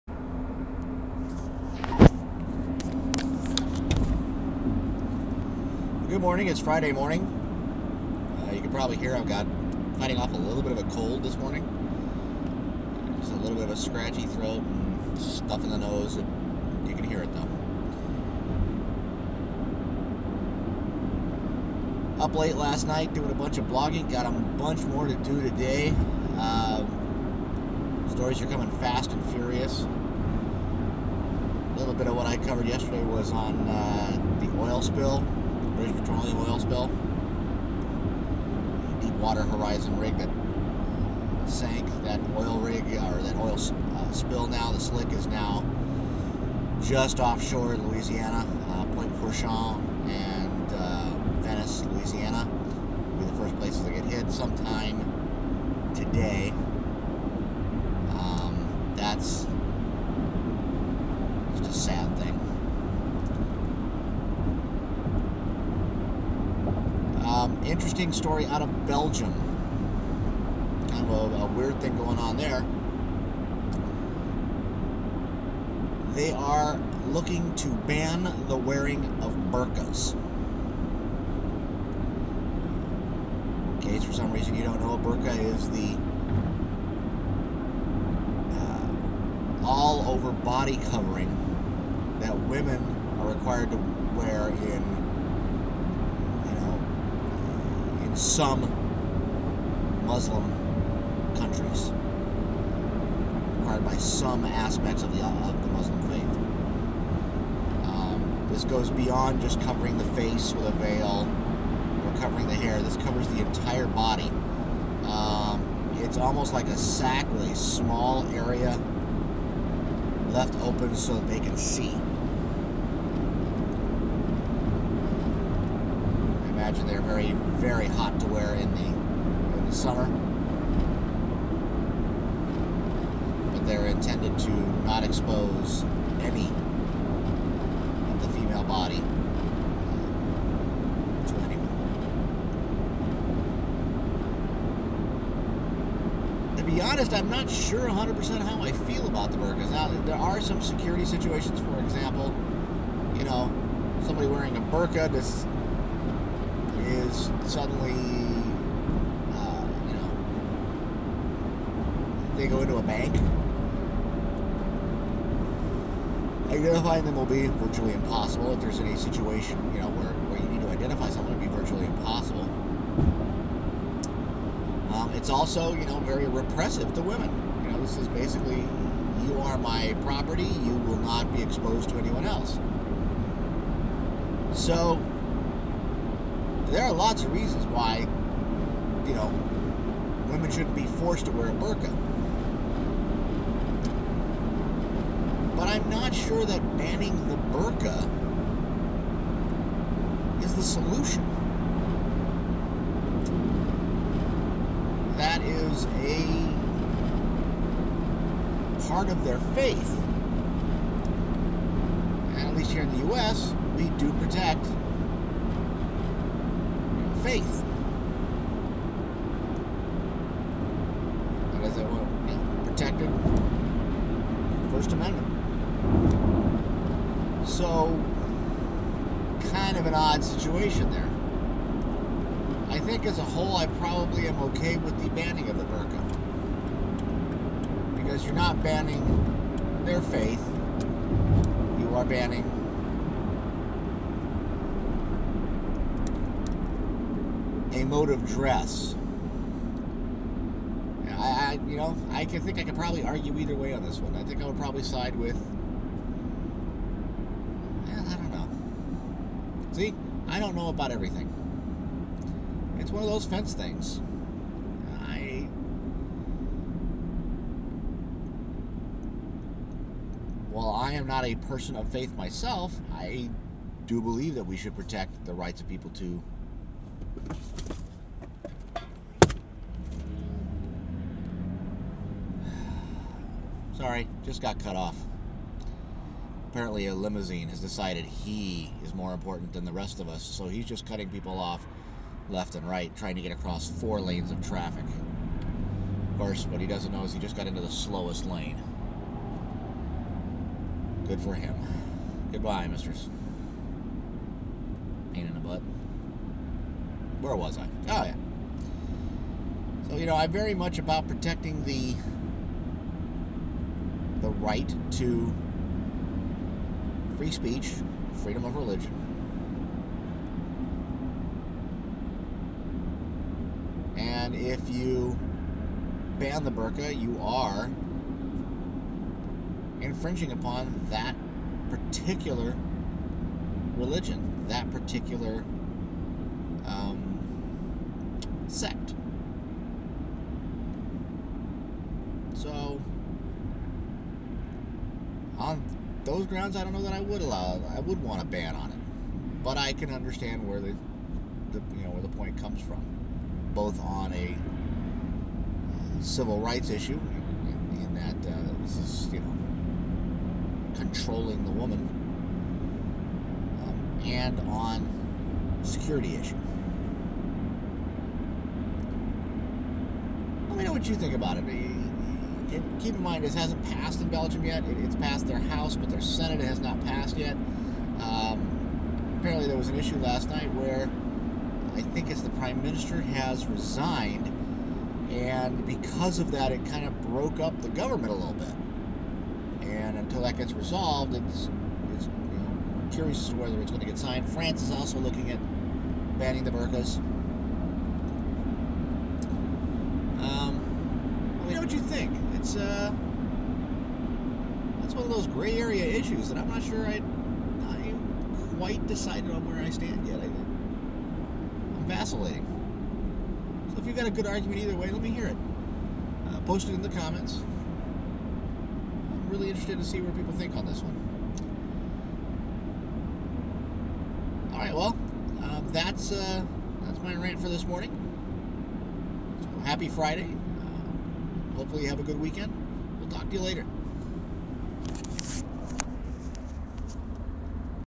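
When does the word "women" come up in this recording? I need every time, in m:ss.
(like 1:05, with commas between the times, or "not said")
1:32, 2:57, 3:10.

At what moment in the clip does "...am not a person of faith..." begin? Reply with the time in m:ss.
4:30.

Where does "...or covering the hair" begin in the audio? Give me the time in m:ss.
1:52.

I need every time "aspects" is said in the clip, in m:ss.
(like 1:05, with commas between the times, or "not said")
1:44.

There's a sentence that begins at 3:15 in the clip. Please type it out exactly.
But I'm not sure that banning the burqa is the solution.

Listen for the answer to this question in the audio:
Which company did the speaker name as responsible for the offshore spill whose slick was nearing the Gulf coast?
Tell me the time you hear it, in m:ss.
0:35.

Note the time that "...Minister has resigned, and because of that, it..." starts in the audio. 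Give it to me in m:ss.
6:22.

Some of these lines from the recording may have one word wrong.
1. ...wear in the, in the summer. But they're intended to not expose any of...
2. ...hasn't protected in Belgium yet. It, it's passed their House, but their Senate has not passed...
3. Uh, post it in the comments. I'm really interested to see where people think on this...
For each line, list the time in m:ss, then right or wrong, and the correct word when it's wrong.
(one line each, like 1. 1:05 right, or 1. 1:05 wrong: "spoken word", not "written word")
1. 2:08 right
2. 6:13 wrong: "passed", not "protected"
3. 6:56 right.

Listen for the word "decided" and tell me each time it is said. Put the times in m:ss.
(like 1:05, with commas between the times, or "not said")
4:47, 6:48.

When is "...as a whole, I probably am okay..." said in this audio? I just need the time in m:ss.
3:53.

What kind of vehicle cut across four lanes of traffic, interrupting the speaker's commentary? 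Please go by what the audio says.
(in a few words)
a limousine.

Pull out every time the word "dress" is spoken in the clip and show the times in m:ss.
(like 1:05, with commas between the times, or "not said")
4:08.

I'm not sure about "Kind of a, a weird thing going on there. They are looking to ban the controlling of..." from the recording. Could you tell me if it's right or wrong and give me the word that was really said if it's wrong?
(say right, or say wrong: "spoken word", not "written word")
wrong: "wearing", not "controlling".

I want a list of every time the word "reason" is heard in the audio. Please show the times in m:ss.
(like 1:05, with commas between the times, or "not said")
1:24, 3:07.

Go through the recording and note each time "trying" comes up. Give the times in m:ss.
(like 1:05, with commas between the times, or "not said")
4:52.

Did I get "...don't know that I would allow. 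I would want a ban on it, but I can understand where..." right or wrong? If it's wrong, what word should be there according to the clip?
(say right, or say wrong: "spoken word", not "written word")
right.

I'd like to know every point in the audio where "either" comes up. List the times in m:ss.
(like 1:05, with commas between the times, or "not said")
4:13, 6:54.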